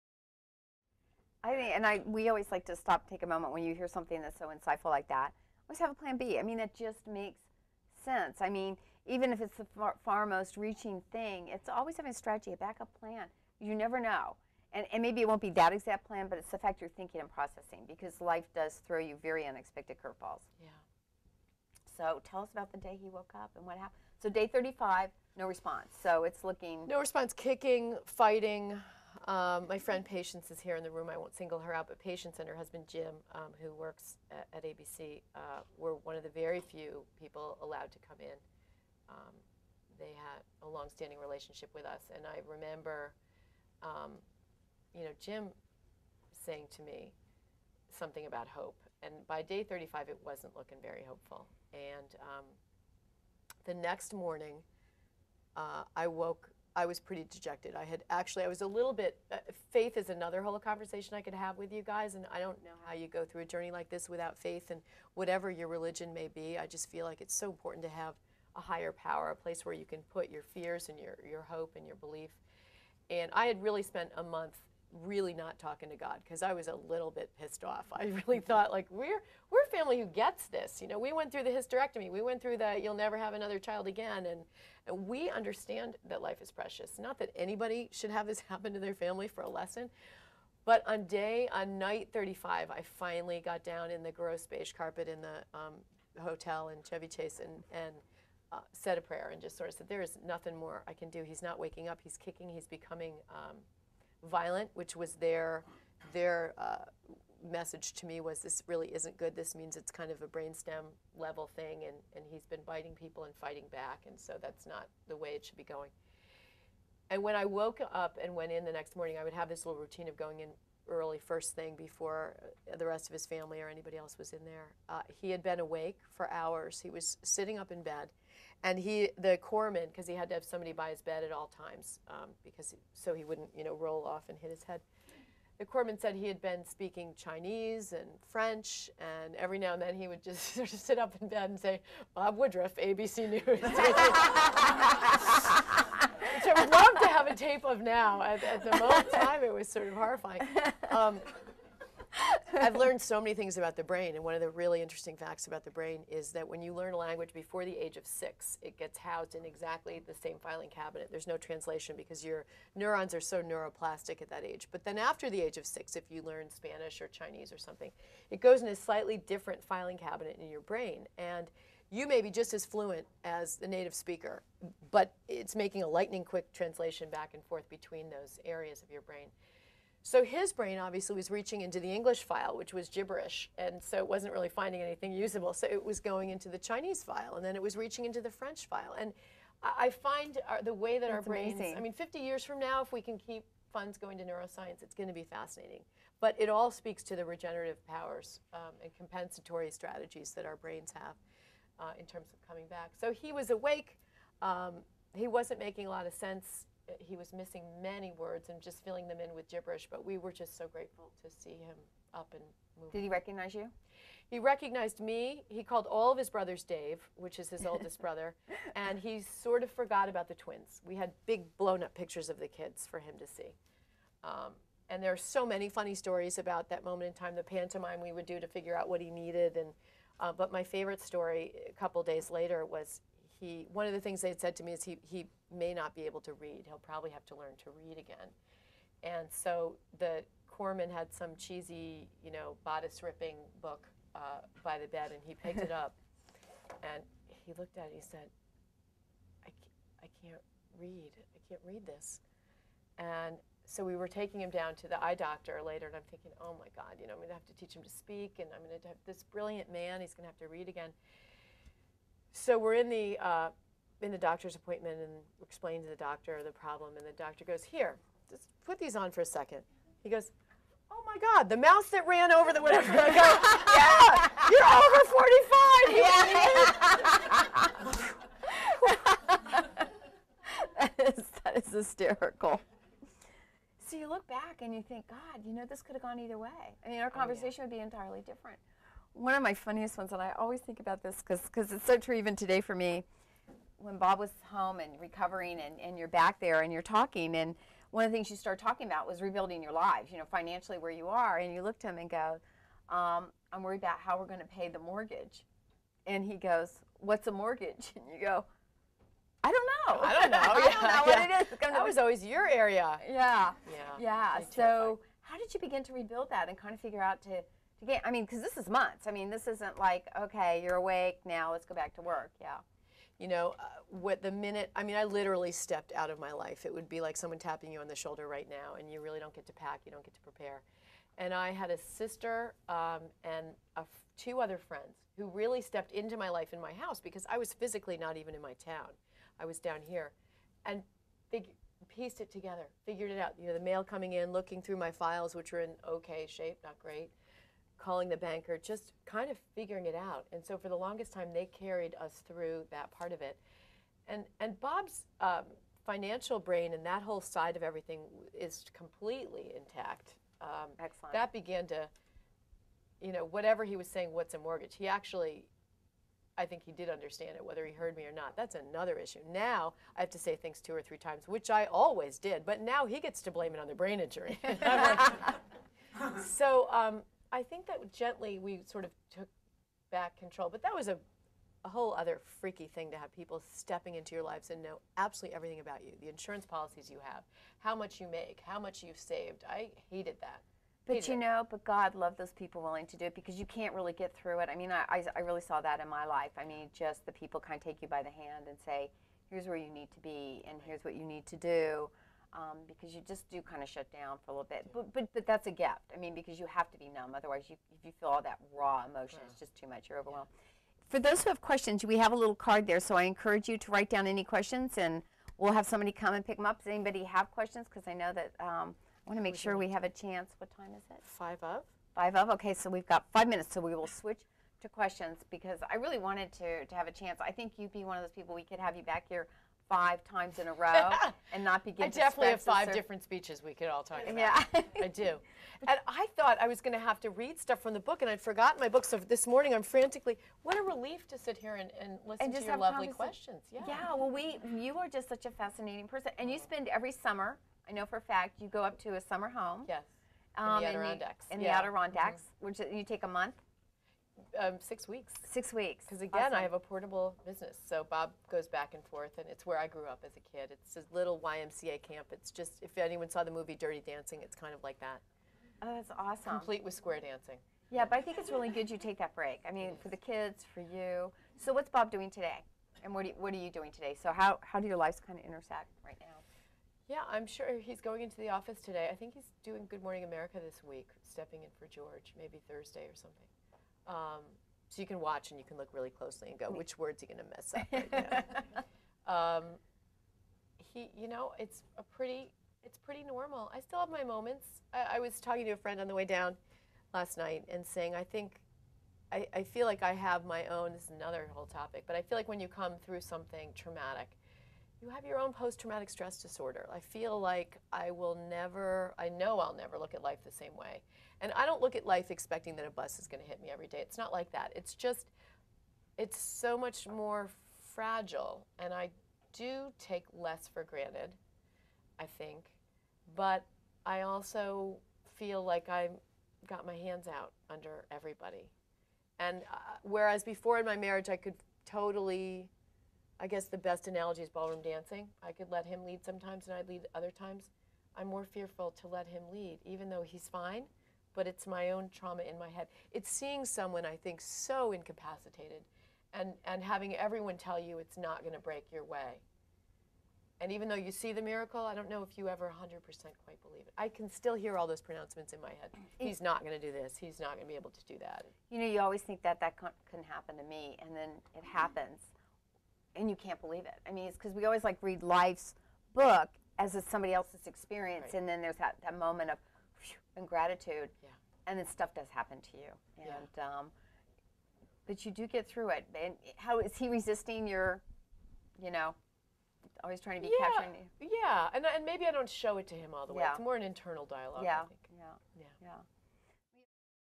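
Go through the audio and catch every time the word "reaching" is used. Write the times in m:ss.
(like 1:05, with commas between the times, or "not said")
0:10, 3:01, 3:07.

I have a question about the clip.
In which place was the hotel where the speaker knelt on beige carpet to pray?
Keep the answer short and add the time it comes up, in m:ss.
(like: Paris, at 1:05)
Chevy Chase, at 1:36.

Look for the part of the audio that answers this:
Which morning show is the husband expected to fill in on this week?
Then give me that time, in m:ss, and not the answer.
7:59.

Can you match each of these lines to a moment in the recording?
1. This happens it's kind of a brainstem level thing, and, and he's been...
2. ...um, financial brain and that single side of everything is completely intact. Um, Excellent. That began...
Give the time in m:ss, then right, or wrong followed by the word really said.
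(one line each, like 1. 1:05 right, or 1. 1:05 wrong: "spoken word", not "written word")
1. 1:49 wrong: "means", not "happens"
2. 5:55 wrong: "whole", not "single".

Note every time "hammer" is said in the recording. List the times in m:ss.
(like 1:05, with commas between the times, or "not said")
not said.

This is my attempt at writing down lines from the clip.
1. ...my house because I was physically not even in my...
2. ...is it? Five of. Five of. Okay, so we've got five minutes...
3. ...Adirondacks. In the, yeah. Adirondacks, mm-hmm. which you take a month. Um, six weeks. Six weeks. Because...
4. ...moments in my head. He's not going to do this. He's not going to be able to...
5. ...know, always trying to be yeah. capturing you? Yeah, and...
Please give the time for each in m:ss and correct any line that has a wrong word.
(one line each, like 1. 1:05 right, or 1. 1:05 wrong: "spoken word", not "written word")
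1. 5:36 right
2. 7:00 right
3. 7:30 right
4. 9:14 wrong: "pronouncements", not "moments"
5. 9:38 right.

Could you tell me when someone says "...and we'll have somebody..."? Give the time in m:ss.
6:54.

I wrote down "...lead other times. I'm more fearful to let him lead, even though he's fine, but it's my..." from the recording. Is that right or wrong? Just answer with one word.
right.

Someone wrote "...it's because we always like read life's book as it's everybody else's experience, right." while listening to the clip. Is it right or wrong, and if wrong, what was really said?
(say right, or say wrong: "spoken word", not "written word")
wrong: "somebody", not "everybody".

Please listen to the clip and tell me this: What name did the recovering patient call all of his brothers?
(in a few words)
Dave.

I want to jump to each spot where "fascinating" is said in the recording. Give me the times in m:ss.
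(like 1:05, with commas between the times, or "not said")
3:15, 7:25.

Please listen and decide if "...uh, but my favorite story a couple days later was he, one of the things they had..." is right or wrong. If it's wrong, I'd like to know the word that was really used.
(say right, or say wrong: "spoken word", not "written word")
right.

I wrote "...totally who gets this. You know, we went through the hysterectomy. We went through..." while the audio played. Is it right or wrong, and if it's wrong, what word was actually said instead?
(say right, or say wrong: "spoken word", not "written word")
wrong: "family", not "totally".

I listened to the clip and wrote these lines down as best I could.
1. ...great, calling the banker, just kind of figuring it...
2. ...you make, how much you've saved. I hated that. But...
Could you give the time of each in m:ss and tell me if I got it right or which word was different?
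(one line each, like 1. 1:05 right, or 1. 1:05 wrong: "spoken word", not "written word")
1. 5:46 right
2. 6:27 right.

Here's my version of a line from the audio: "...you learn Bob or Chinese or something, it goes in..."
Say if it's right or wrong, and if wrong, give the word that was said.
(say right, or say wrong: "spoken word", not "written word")
wrong: "Spanish", not "Bob".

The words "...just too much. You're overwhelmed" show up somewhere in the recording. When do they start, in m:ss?
6:49.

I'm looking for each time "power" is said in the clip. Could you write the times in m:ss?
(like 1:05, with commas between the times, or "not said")
1:08, 3:17.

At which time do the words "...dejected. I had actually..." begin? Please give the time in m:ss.
0:57.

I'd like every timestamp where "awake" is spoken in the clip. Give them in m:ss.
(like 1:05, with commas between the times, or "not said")
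2:05, 3:23, 5:20.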